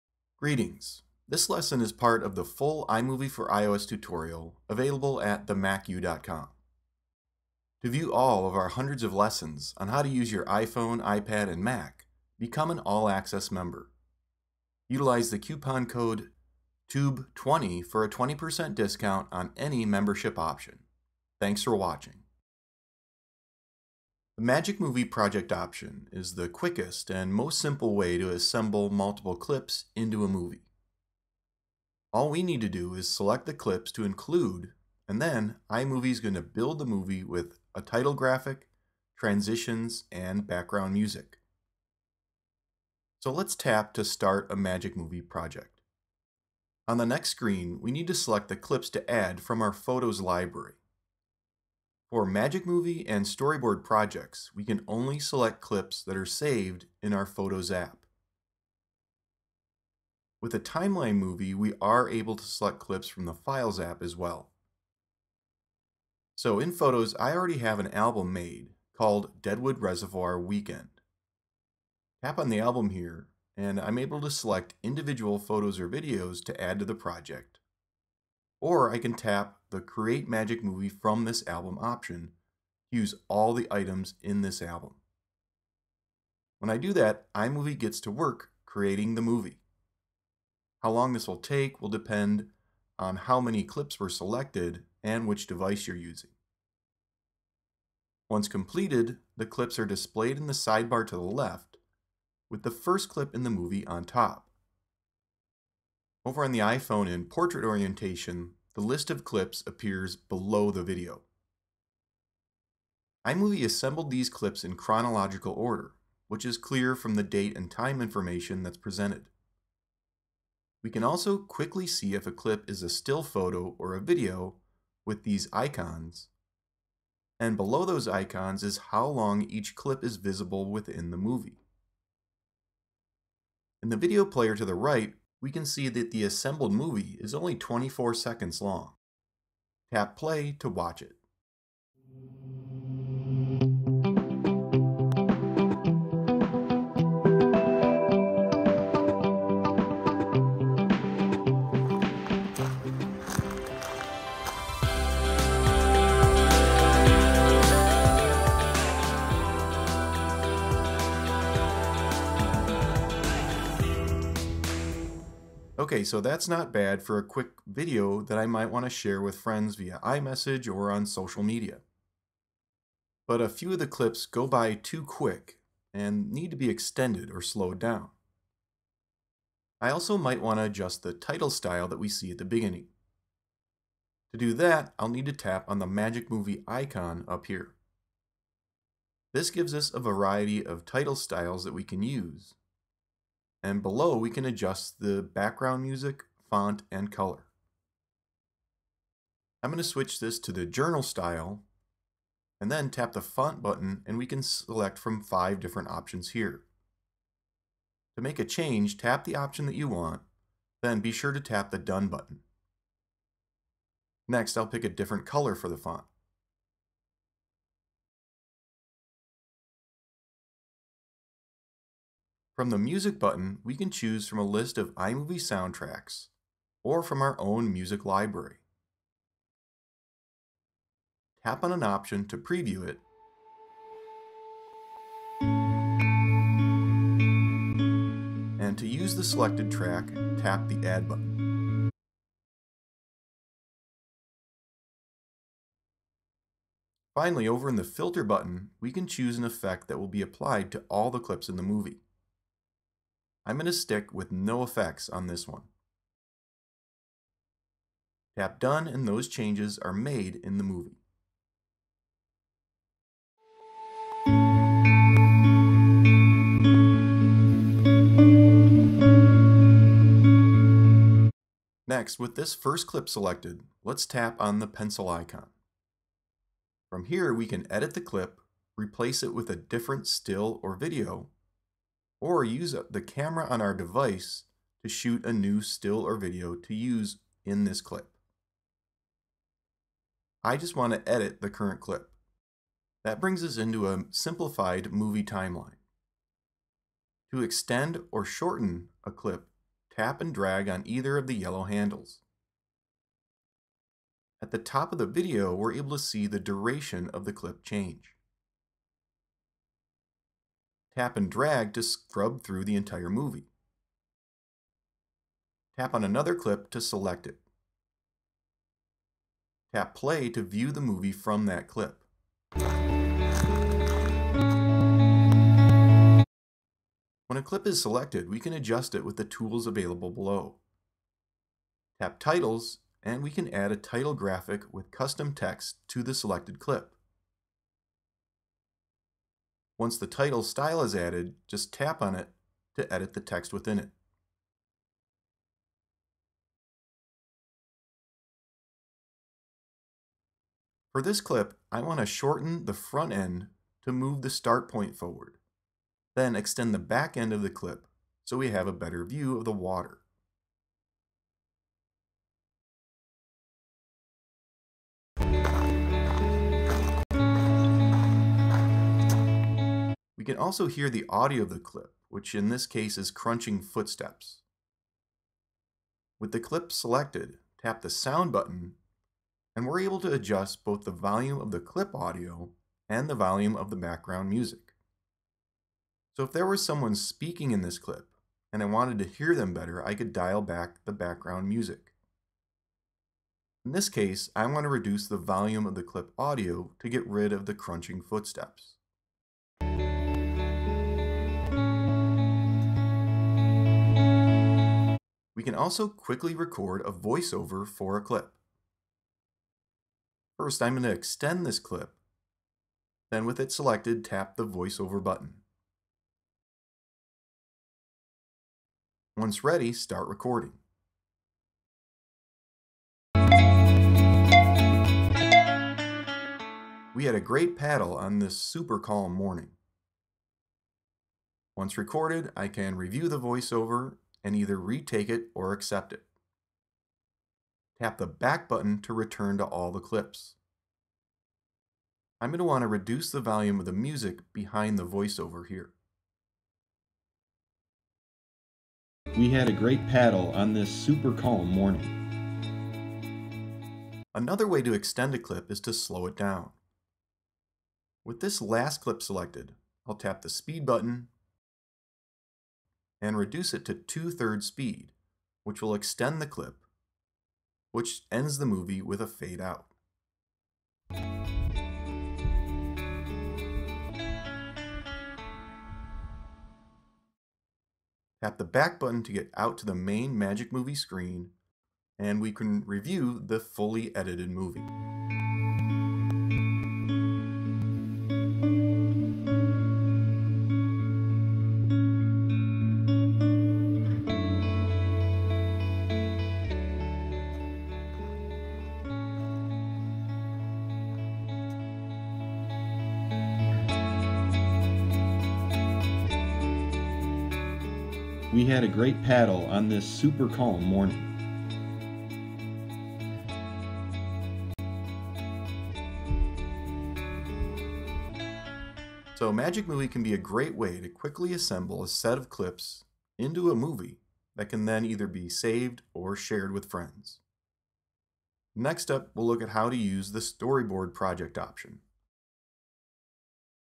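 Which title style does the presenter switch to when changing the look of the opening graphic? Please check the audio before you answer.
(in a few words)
journal.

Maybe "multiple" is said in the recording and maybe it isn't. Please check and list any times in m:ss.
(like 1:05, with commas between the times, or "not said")
0:28.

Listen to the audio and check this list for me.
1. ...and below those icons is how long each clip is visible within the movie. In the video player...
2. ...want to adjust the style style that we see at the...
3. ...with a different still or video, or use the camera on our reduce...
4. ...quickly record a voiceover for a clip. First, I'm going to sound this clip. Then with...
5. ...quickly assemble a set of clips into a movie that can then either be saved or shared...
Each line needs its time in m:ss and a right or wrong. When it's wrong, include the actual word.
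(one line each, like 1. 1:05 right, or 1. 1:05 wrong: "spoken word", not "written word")
1. 2:07 right
2. 3:00 wrong: "title", not "style"
3. 4:39 wrong: "device", not "reduce"
4. 6:45 wrong: "extend", not "sound"
5. 8:40 right.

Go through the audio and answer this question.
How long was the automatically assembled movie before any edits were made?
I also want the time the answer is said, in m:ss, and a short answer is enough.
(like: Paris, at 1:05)
24 seconds, at 2:17.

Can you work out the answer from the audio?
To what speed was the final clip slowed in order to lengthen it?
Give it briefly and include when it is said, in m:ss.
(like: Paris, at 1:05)
two-thirds speed, at 7:43.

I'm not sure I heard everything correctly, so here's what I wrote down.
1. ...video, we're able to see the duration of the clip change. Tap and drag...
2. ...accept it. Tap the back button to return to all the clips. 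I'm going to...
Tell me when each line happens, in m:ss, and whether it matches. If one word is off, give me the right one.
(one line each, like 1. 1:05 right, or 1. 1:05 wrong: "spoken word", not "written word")
1. 5:05 right
2. 7:15 right.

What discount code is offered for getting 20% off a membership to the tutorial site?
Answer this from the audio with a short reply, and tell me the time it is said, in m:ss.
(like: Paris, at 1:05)
TUBE20, at 0:16.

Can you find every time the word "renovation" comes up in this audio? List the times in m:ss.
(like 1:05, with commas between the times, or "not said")
not said.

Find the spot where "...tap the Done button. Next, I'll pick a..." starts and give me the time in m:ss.
3:31.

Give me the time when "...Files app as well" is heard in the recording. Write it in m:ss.
1:03.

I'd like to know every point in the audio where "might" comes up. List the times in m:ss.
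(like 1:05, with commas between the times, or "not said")
2:48, 3:00.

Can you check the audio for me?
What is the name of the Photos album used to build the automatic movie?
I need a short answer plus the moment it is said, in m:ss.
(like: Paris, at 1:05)
Deadwood Reservoir Weekend, at 1:09.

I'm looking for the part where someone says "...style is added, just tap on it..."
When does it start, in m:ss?
5:40.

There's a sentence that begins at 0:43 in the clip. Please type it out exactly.
So let's tap to start a Magic Movie project.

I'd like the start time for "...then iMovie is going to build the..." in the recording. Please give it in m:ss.
0:35.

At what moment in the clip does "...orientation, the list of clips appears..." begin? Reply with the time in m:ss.
1:47.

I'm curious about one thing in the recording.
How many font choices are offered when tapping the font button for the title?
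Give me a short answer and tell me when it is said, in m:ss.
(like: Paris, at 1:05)
5, at 3:25.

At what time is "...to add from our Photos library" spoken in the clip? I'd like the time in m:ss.
0:48.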